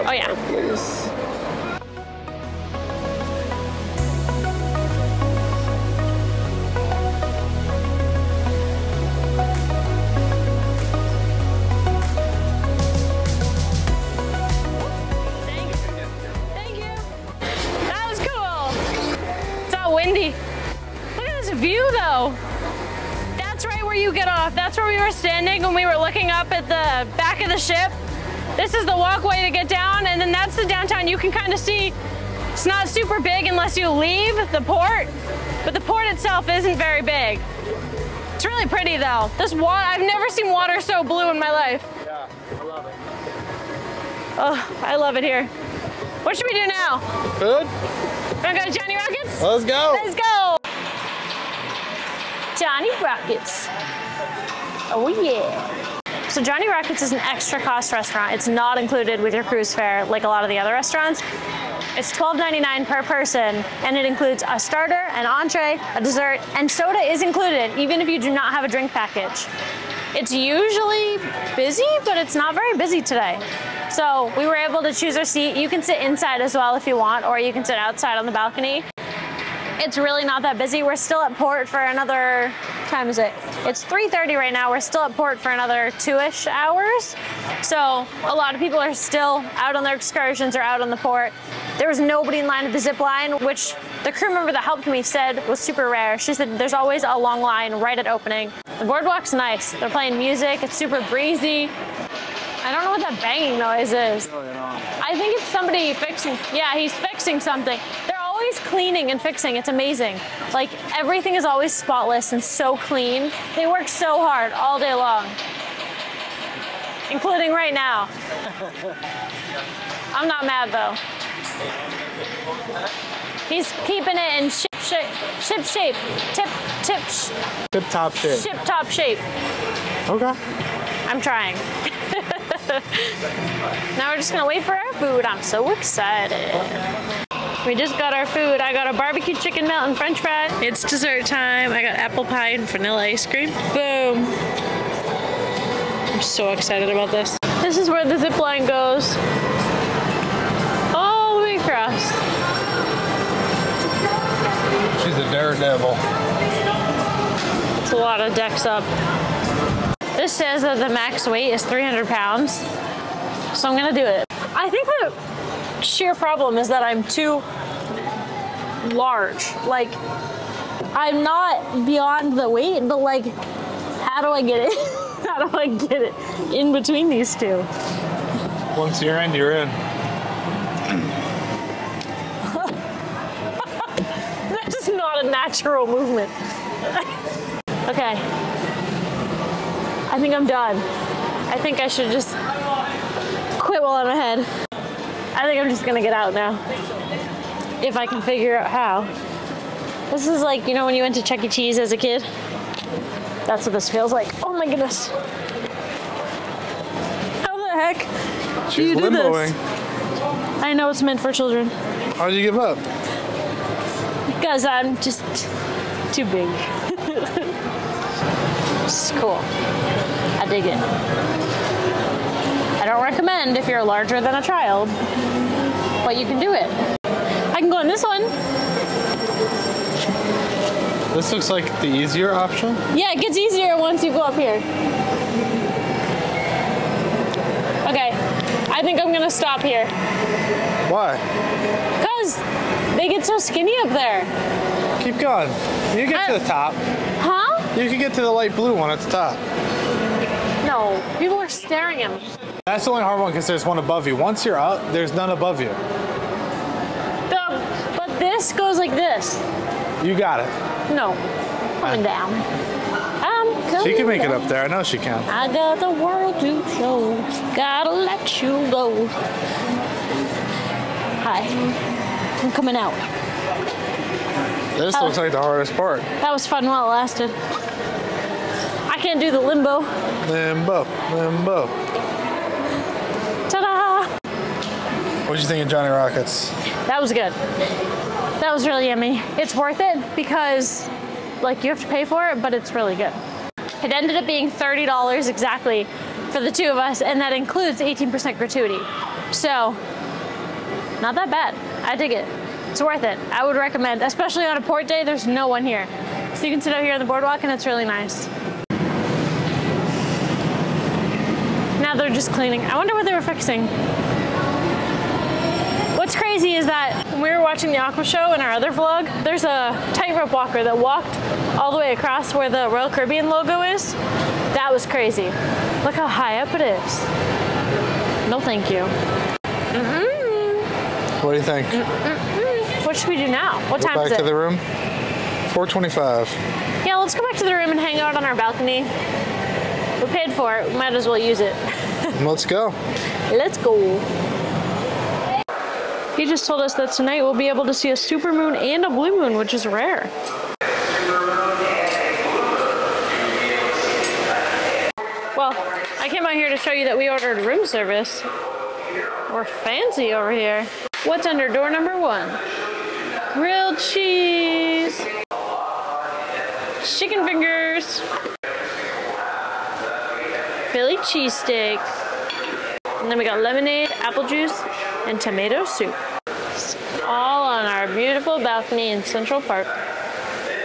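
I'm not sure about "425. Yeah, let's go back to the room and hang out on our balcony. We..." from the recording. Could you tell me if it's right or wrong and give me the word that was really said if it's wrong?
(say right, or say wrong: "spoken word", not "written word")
right.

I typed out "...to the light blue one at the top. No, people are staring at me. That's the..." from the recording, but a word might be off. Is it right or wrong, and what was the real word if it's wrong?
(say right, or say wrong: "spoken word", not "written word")
right.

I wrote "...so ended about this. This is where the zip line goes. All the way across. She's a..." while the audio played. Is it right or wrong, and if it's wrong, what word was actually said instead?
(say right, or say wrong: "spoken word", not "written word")
wrong: "excited", not "ended".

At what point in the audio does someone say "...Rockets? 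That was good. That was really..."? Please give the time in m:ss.
4:45.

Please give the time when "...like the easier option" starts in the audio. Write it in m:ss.
3:51.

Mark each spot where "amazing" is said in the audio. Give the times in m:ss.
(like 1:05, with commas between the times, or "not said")
1:49.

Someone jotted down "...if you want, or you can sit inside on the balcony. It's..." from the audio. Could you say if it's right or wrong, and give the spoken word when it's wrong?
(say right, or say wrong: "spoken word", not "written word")
wrong: "outside", not "inside".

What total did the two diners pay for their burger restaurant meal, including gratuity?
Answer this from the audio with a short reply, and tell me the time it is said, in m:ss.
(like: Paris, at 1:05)
$30, at 4:54.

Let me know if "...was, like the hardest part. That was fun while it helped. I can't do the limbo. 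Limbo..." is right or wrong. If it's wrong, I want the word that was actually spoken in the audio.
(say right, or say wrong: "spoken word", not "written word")
wrong: "lasted", not "helped".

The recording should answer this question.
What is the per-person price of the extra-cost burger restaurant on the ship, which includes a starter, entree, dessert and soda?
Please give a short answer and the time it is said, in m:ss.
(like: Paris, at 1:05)
$12.99, at 1:02.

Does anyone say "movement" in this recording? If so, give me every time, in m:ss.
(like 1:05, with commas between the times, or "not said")
3:05.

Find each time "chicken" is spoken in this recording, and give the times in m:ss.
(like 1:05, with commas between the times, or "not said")
2:19, 6:06.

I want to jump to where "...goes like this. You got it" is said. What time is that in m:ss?
4:18.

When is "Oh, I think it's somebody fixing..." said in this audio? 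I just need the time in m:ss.
1:44.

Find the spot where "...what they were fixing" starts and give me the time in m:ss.
5:12.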